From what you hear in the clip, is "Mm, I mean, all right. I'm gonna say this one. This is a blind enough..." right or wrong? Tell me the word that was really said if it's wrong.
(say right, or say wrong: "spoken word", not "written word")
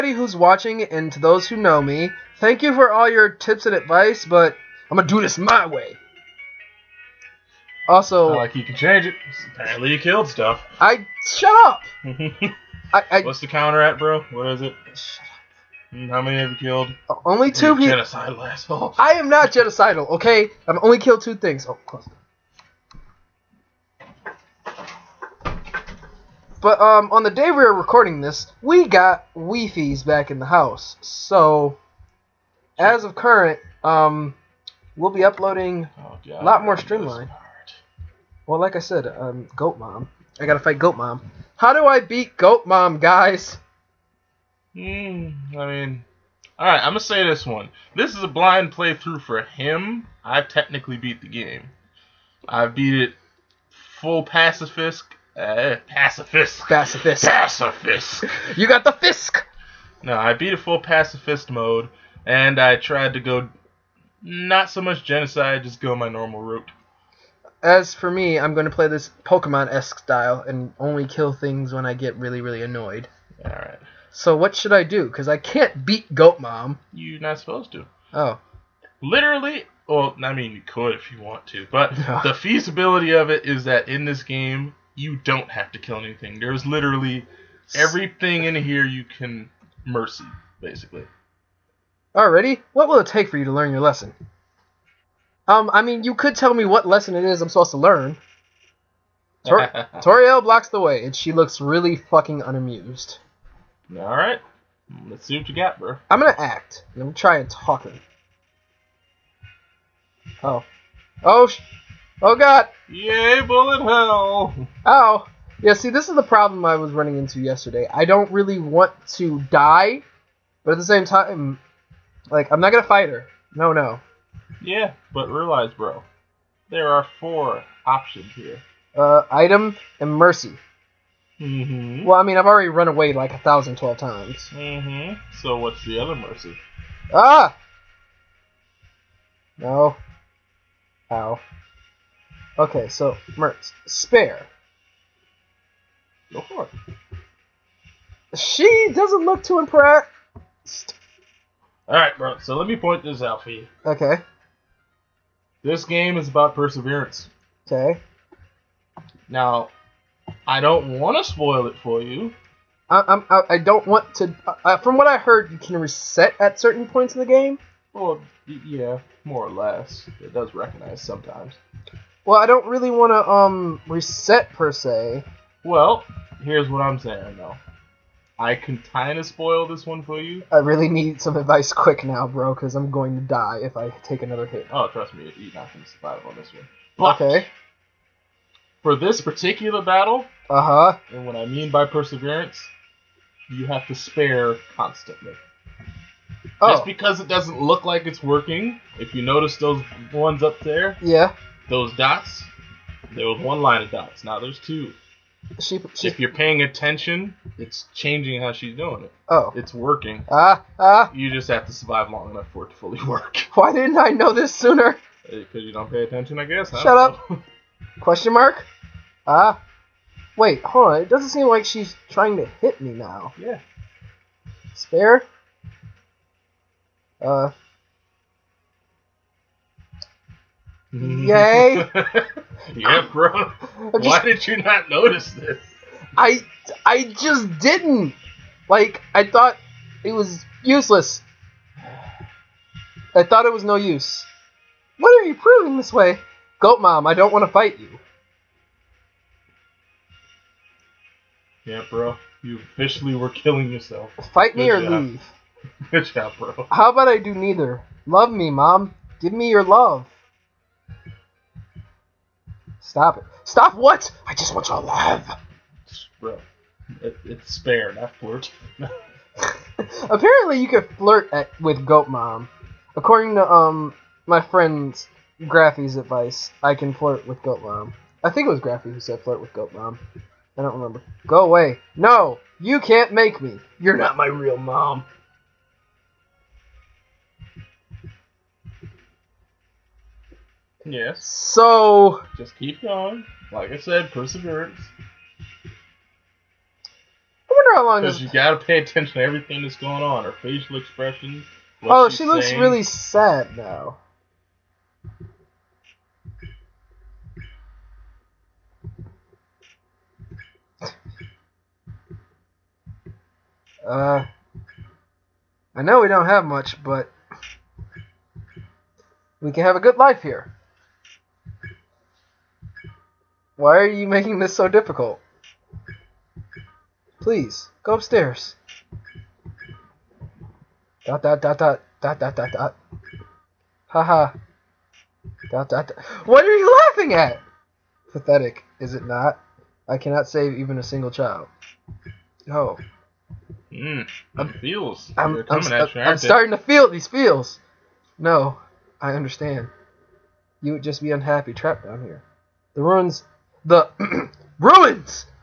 wrong: "playthrough", not "enough".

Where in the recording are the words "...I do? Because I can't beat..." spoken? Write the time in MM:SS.
01:14.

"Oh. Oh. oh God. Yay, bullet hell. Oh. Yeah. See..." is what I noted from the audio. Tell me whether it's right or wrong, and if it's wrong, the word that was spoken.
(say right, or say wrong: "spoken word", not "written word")
right.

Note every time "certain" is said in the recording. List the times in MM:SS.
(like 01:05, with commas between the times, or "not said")
02:46.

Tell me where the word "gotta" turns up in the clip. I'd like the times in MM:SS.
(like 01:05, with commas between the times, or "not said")
00:40, 04:58.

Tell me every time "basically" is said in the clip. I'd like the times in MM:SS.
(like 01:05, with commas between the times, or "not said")
01:30.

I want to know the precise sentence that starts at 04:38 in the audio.
I think it was Graffy who said flirt with Goat Mom.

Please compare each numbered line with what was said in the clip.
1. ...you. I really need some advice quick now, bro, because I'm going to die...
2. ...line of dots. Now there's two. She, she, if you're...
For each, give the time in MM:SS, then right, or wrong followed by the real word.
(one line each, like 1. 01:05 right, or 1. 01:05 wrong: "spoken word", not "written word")
1. 03:00 right
2. 03:23 right.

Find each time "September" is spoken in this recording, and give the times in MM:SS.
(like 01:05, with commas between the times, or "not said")
not said.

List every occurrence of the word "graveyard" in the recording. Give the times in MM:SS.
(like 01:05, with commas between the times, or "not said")
not said.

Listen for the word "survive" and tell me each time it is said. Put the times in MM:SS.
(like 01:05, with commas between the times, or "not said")
03:05, 03:31.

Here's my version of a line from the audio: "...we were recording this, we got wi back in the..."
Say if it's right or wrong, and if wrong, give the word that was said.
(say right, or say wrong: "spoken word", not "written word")
right.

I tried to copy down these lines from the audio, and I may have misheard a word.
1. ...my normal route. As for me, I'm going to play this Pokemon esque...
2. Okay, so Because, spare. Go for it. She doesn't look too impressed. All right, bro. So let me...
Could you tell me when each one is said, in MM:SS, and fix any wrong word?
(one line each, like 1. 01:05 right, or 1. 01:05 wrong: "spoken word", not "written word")
1. 01:05 right
2. 02:22 wrong: "Mertz", not "Because".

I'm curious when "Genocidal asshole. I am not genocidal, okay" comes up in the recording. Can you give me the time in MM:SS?
00:17.